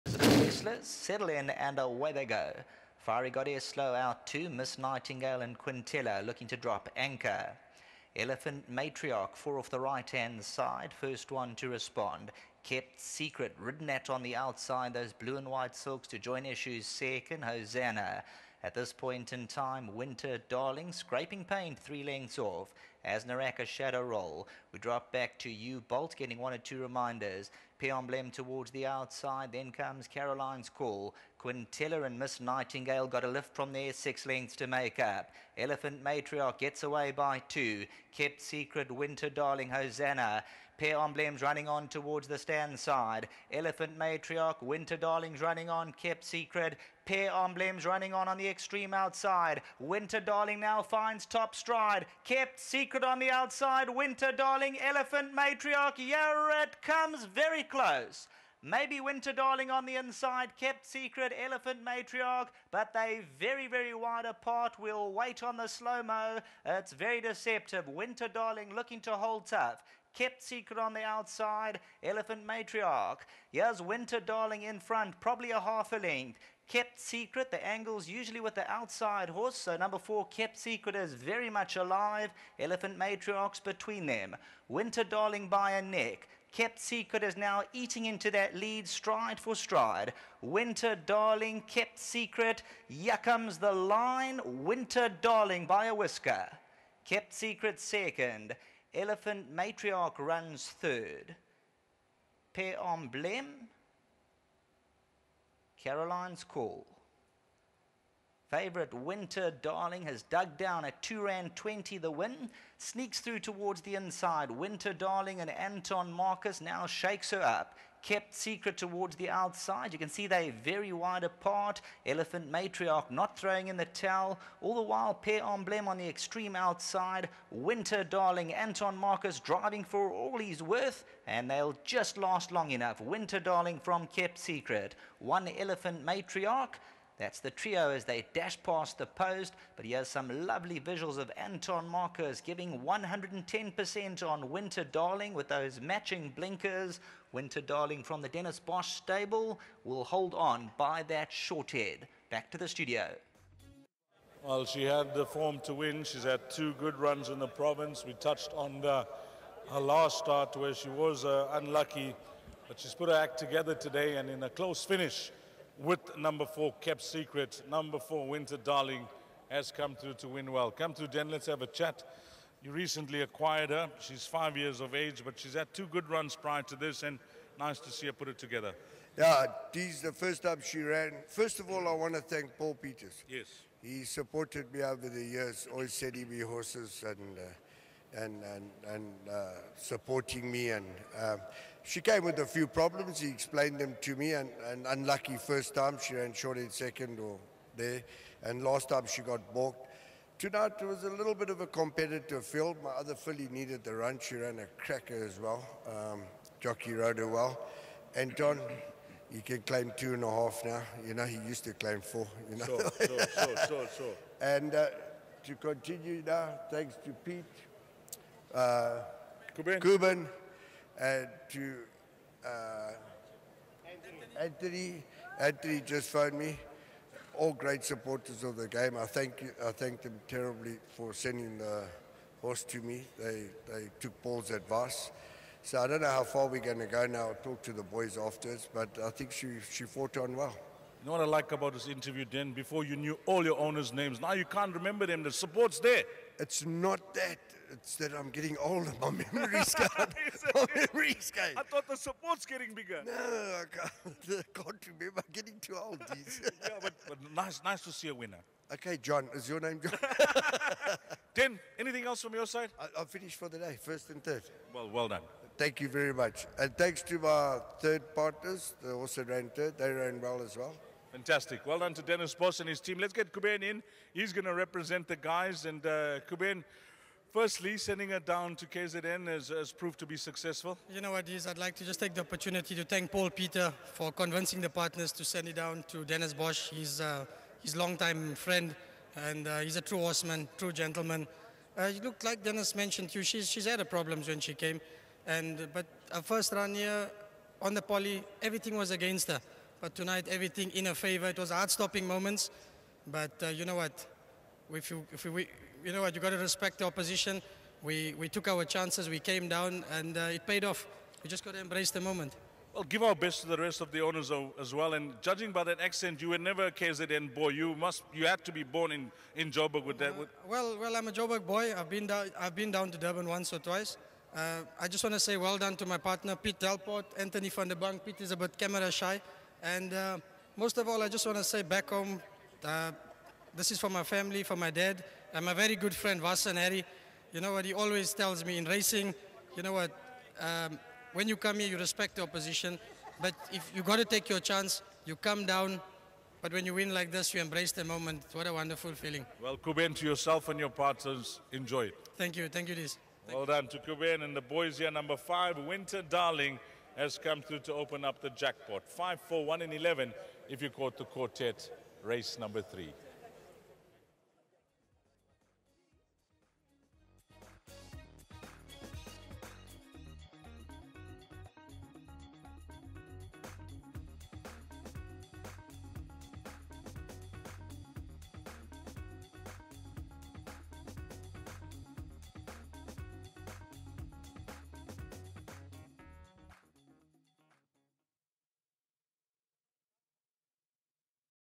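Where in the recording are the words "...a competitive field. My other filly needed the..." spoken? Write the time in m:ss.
3:21.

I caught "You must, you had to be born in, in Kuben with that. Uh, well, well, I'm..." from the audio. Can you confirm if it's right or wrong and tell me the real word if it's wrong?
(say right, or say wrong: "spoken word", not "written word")
wrong: "Joburg", not "Kuben".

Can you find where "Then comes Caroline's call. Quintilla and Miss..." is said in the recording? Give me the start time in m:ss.
0:29.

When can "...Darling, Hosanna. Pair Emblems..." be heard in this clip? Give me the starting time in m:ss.
0:39.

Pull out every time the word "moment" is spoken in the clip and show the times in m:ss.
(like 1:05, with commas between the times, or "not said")
5:02, 5:11, 5:47.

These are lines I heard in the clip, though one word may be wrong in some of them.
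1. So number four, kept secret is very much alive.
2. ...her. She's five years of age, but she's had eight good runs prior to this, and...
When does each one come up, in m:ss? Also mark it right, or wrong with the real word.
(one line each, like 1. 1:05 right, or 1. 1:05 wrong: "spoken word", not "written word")
1. 1:19 right
2. 2:53 wrong: "two", not "eight".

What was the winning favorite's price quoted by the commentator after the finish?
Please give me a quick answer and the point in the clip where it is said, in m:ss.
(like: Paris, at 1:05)
2 Rand 20, at 1:51.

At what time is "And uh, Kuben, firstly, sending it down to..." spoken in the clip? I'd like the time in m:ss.
4:35.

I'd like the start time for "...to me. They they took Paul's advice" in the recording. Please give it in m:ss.
3:52.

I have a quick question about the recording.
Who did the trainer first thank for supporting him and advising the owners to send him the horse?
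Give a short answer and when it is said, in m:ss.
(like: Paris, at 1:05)
Paul Peters, at 3:02.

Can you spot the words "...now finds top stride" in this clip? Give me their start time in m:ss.
0:50.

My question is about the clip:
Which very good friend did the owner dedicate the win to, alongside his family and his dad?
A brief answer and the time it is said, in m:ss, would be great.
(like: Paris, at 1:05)
Vasan Harry, at 5:36.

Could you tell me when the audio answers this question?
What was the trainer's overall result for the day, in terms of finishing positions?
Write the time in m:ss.
4:23.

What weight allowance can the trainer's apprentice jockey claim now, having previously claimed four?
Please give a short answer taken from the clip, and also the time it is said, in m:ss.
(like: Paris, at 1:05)
2.5, at 3:29.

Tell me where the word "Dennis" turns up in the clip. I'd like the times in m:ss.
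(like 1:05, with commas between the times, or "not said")
2:28, 4:32, 4:46, 4:52.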